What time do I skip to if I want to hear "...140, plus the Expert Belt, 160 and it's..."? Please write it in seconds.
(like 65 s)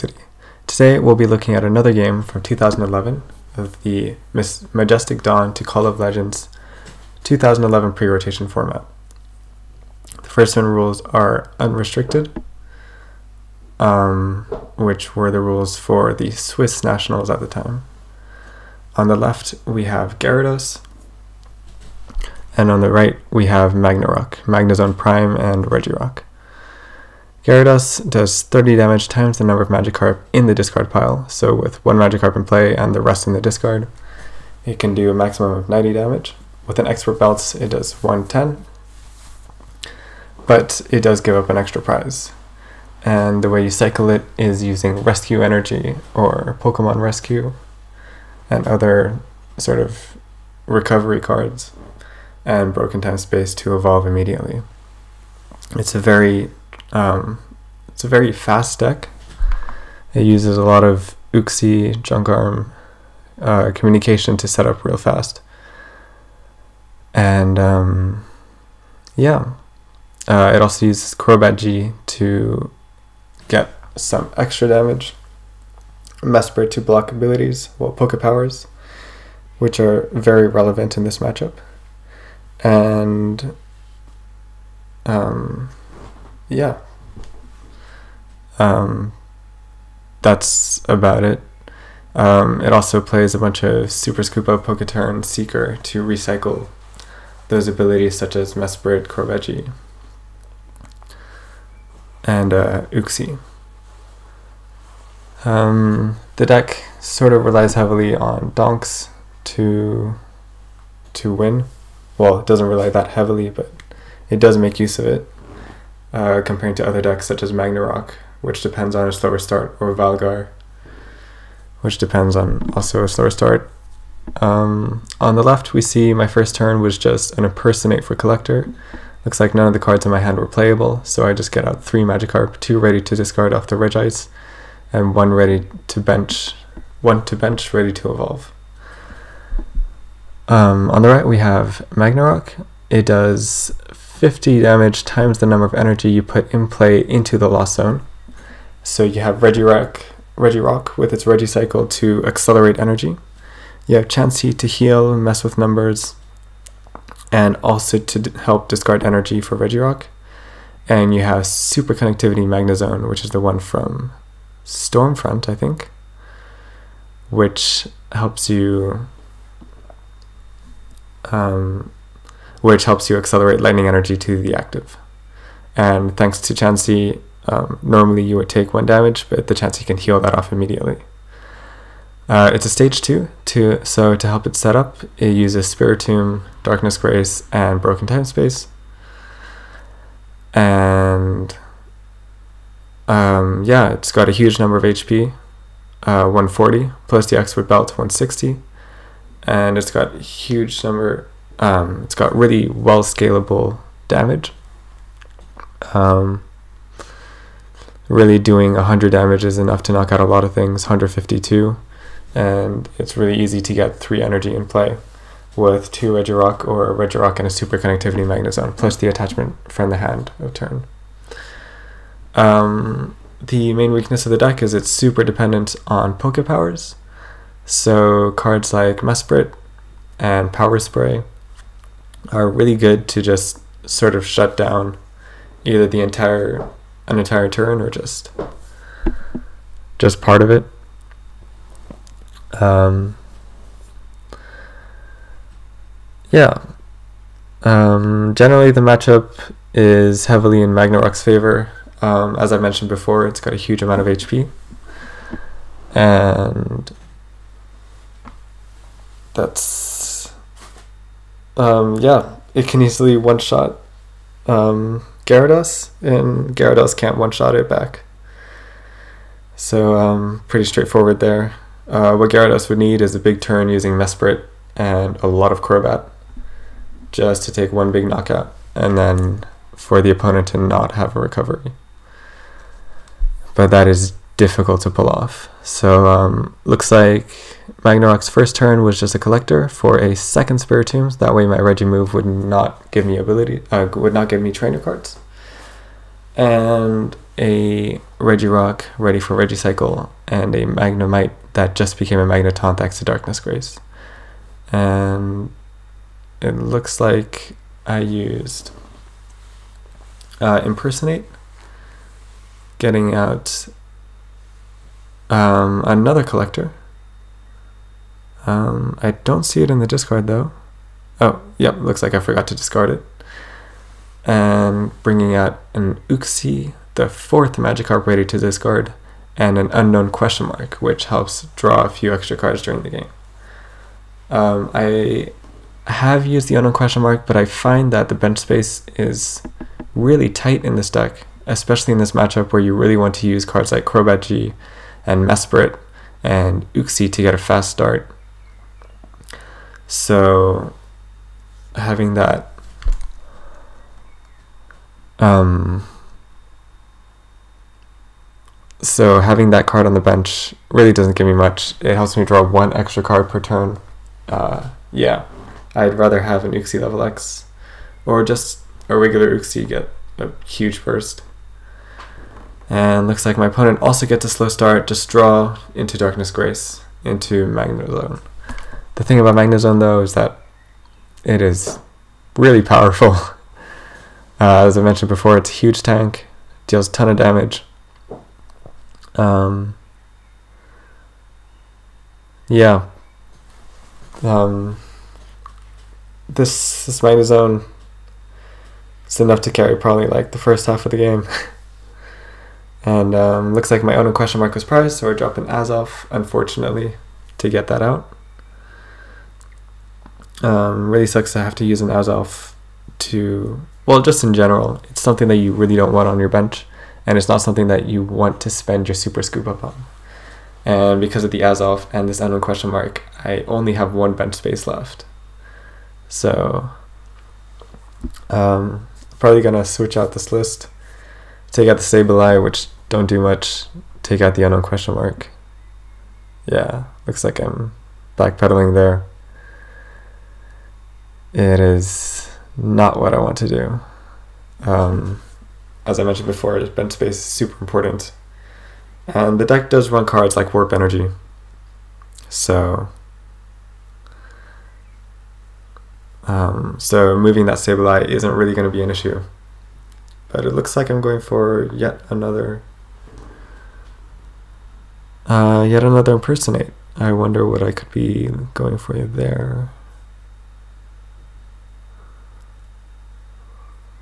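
196 s.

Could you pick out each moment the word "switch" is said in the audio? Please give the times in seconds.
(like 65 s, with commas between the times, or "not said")
429 s.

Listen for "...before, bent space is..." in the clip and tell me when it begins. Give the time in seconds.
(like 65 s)
446 s.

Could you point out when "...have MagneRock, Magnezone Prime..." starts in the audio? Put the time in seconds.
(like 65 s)
23 s.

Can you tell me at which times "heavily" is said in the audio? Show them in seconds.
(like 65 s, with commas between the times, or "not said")
107 s, 113 s, 250 s.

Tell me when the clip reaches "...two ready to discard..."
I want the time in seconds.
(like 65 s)
132 s.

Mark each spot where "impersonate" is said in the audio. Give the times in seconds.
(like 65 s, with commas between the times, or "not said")
127 s, 310 s, 466 s.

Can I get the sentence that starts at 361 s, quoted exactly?
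It helps me draw one extra card per turn.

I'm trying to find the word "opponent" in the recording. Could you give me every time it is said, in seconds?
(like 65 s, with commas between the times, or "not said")
280 s, 373 s.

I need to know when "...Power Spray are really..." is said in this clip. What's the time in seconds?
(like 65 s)
230 s.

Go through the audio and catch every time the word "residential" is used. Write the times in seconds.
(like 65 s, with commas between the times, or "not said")
not said.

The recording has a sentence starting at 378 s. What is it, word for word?
The thing about Zone, though is that it is really powerful.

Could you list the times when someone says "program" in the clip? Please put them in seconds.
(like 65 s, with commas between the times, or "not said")
not said.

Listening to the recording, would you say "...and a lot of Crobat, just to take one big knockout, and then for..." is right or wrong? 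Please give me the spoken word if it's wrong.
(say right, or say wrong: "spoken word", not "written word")
right.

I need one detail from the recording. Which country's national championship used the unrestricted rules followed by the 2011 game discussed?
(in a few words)
Swiss.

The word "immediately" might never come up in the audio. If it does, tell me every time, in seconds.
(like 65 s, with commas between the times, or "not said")
54 s, 180 s.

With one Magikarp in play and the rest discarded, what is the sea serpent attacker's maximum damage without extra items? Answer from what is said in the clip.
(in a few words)
90.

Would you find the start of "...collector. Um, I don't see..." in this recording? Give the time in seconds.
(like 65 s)
316 s.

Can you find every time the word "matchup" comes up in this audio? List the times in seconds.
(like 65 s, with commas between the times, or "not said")
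81 s, 248 s, 342 s.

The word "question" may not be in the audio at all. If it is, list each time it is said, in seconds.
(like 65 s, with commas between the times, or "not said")
330 s, 336 s, 404 s, 422 s, 434 s.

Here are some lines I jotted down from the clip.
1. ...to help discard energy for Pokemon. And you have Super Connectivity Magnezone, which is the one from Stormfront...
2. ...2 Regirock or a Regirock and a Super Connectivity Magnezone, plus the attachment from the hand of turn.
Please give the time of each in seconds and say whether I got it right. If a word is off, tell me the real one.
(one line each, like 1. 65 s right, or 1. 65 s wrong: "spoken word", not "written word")
1. 157 s wrong: "Regirock", not "Pokemon"
2. 215 s right.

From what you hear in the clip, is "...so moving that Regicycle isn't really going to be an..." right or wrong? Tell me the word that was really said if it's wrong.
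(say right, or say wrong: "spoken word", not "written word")
wrong: "Sableye", not "Regicycle".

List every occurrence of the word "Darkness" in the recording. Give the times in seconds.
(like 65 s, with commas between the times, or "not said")
186 s, 303 s, 375 s.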